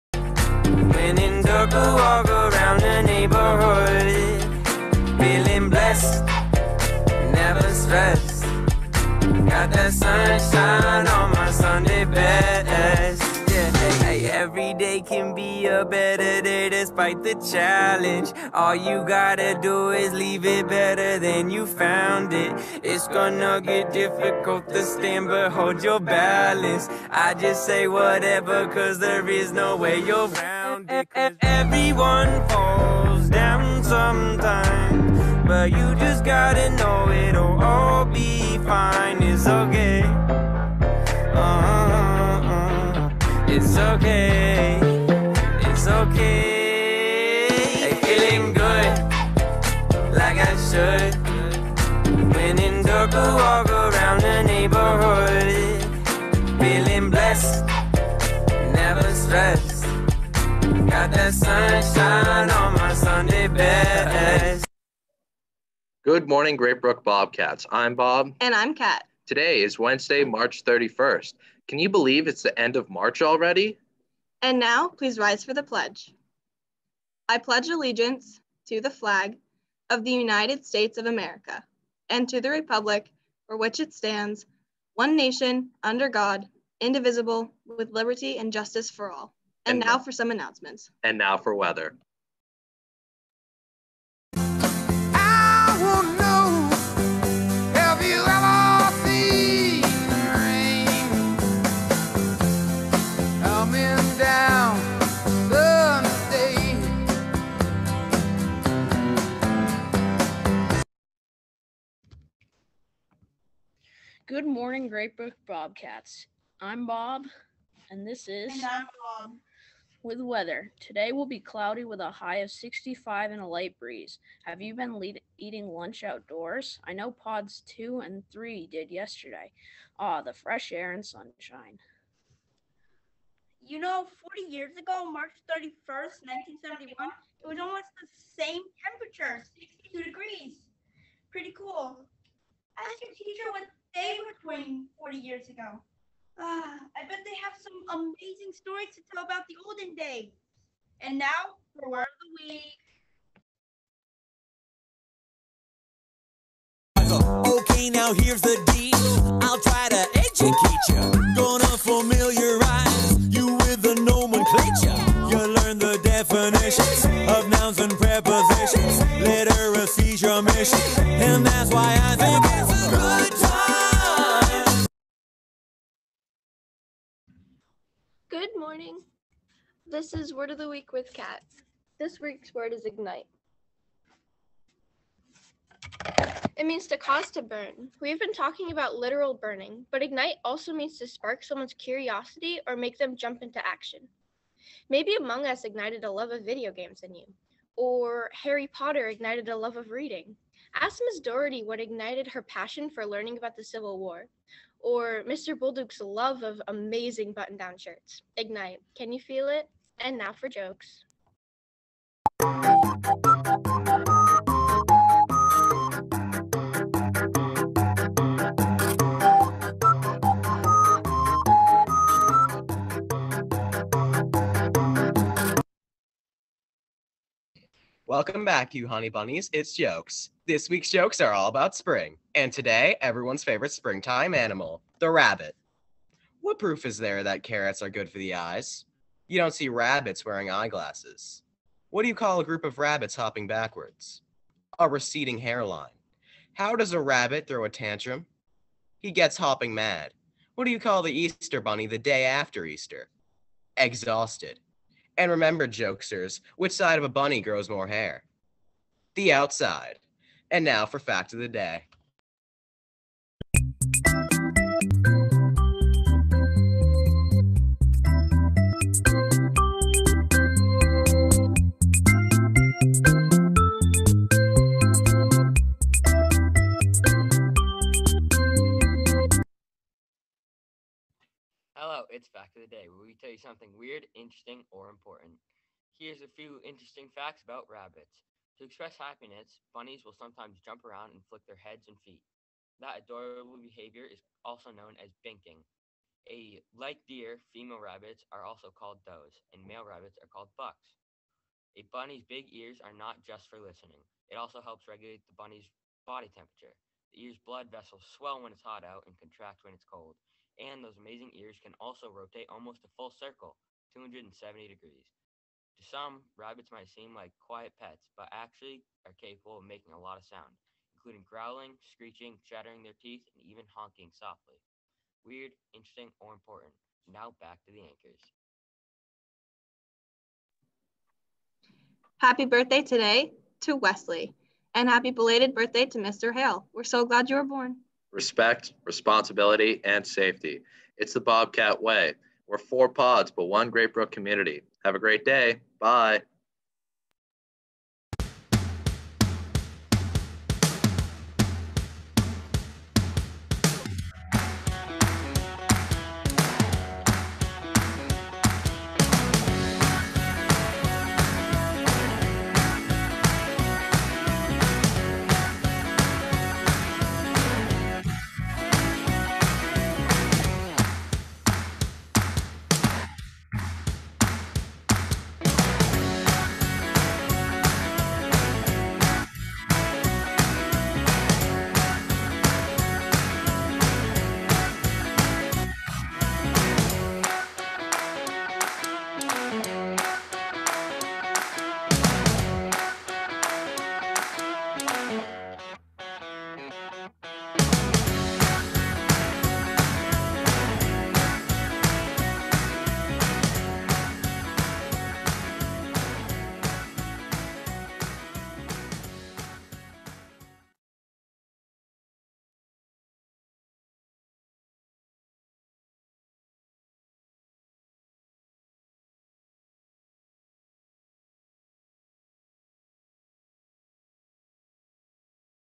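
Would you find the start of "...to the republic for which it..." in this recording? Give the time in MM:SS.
01:22.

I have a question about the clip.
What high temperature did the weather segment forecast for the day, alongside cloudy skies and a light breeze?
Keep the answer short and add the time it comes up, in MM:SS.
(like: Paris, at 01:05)
65, at 02:02.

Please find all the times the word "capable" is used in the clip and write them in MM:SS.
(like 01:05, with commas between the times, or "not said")
05:19.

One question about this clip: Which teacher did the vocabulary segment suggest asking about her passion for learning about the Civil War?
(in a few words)
Ms. Doherty.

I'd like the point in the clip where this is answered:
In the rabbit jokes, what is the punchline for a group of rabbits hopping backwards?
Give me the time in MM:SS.
04:04.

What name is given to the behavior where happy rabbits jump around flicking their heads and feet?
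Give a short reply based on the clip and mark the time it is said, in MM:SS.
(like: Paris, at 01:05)
binking, at 04:55.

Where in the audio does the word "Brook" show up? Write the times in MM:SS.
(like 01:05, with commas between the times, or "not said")
01:06, 01:55, 05:43.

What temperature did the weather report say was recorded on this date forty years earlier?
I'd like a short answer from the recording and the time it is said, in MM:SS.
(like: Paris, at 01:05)
62 degrees, at 02:19.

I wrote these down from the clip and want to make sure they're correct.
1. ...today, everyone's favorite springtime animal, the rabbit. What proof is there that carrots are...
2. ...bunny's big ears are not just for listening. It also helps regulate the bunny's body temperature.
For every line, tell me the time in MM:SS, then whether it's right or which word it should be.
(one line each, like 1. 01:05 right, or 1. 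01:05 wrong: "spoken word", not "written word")
1. 03:52 right
2. 05:01 right.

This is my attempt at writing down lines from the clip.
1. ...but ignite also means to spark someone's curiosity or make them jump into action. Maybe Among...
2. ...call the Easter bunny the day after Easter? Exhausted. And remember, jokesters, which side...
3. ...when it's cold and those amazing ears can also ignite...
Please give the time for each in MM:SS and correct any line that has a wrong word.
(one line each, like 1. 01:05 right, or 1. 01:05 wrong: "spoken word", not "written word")
1. 03:09 right
2. 04:10 right
3. 05:09 wrong: "rotate", not "ignite".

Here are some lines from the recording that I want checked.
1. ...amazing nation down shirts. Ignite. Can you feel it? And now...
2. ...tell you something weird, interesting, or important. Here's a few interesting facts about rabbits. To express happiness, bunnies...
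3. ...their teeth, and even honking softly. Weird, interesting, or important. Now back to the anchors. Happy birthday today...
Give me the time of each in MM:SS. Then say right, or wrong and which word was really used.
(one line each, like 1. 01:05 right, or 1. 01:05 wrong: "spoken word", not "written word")
1. 03:26 wrong: "button", not "nation"
2. 04:43 right
3. 05:22 right.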